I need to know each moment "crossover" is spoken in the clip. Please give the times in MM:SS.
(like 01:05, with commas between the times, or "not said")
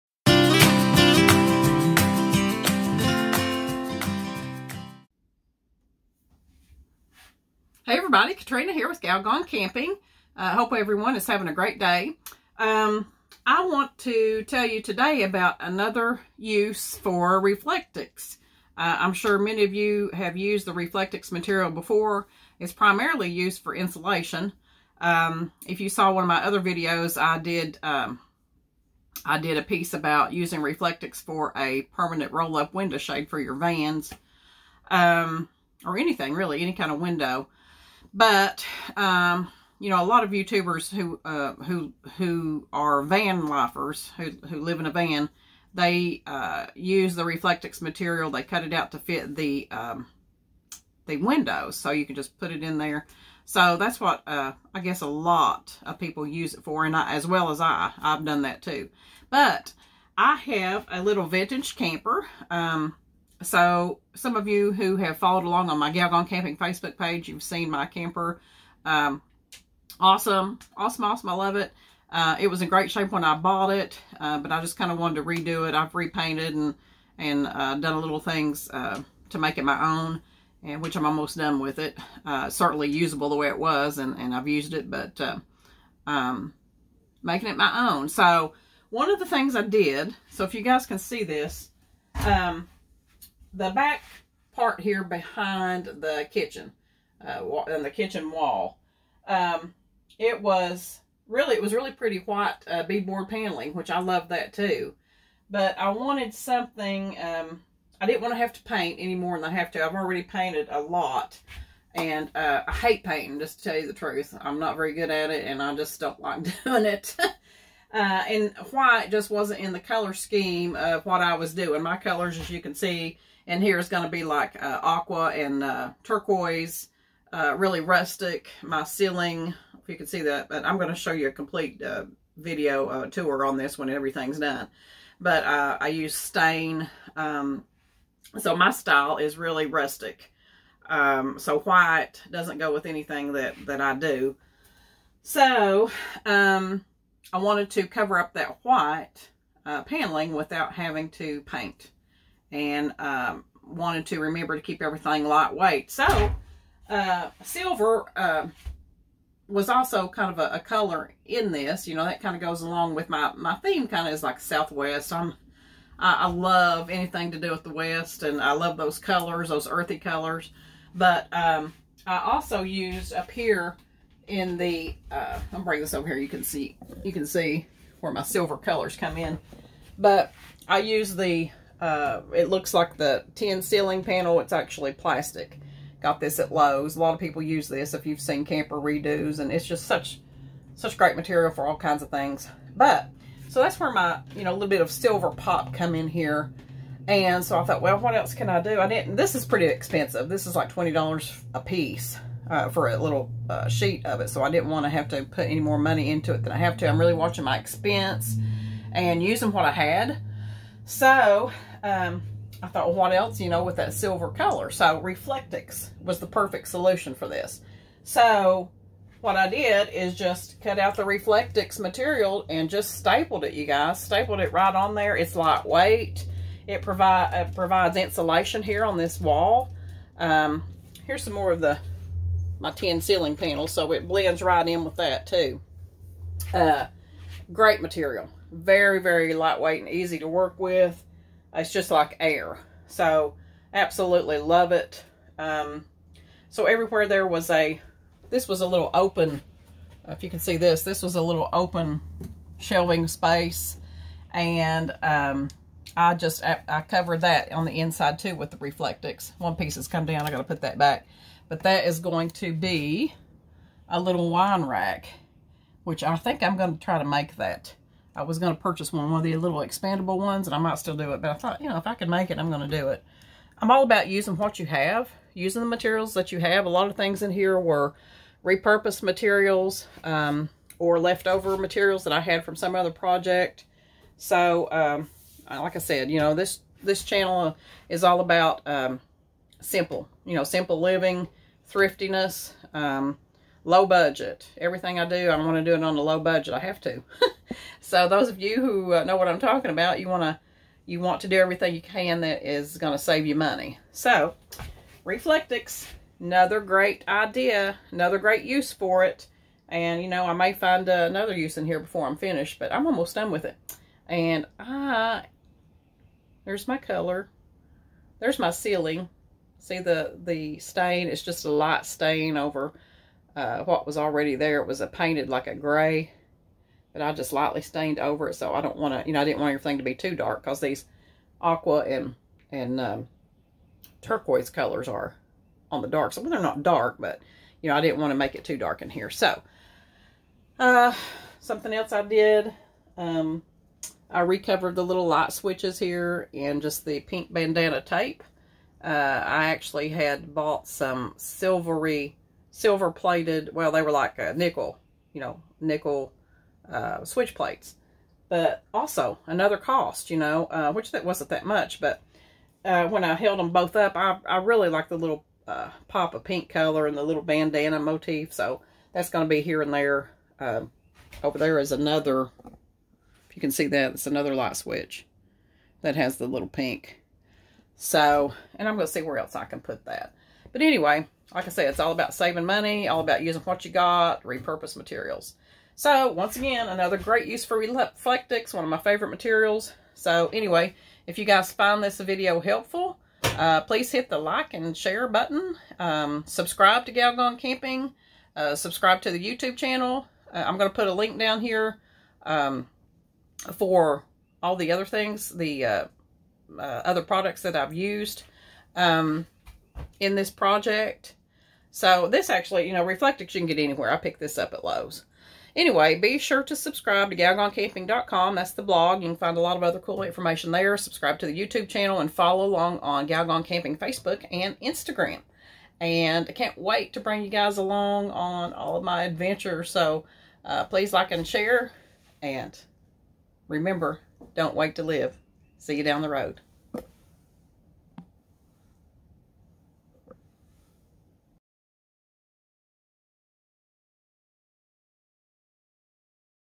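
not said.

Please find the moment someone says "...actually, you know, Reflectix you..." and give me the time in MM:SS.
06:52.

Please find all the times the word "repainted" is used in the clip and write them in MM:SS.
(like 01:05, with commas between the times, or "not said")
01:15.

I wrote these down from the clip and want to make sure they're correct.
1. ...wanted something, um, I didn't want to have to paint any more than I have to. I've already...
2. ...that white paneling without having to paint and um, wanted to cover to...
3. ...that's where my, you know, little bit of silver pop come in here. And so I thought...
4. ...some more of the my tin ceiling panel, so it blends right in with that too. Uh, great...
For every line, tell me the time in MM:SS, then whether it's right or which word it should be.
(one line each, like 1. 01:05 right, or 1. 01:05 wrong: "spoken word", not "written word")
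1. 01:45 right
2. 02:28 wrong: "remember", not "cover"
3. 03:13 right
4. 03:51 right.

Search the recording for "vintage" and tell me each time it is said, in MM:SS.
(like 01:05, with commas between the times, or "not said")
01:01.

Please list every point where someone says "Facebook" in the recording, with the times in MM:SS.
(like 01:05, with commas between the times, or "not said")
01:06, 07:03.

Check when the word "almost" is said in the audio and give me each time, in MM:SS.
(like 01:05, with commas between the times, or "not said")
01:21, 05:12.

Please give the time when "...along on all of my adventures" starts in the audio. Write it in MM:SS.
07:07.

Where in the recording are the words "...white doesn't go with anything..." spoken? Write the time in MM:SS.
02:21.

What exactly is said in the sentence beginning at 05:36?
So well, they're not dark, but, you know, I didn't want to make it too dark in here.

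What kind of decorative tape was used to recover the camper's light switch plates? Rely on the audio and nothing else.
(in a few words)
Pink bandana tape.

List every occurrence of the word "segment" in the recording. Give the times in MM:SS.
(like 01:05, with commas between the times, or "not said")
not said.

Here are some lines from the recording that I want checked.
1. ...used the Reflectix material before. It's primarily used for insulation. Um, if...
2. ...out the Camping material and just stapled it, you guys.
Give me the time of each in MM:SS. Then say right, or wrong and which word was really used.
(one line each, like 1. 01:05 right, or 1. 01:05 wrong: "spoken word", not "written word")
1. 00:20 right
2. 03:40 wrong: "Reflectix", not "Camping".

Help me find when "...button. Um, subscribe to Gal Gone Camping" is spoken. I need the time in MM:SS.
06:35.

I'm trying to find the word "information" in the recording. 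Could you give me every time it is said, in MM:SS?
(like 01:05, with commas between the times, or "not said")
07:00.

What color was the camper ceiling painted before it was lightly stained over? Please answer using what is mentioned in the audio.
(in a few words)
Gray.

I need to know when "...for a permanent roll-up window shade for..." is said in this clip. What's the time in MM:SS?
00:31.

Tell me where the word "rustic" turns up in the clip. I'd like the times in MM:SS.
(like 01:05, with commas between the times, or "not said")
02:07, 02:19.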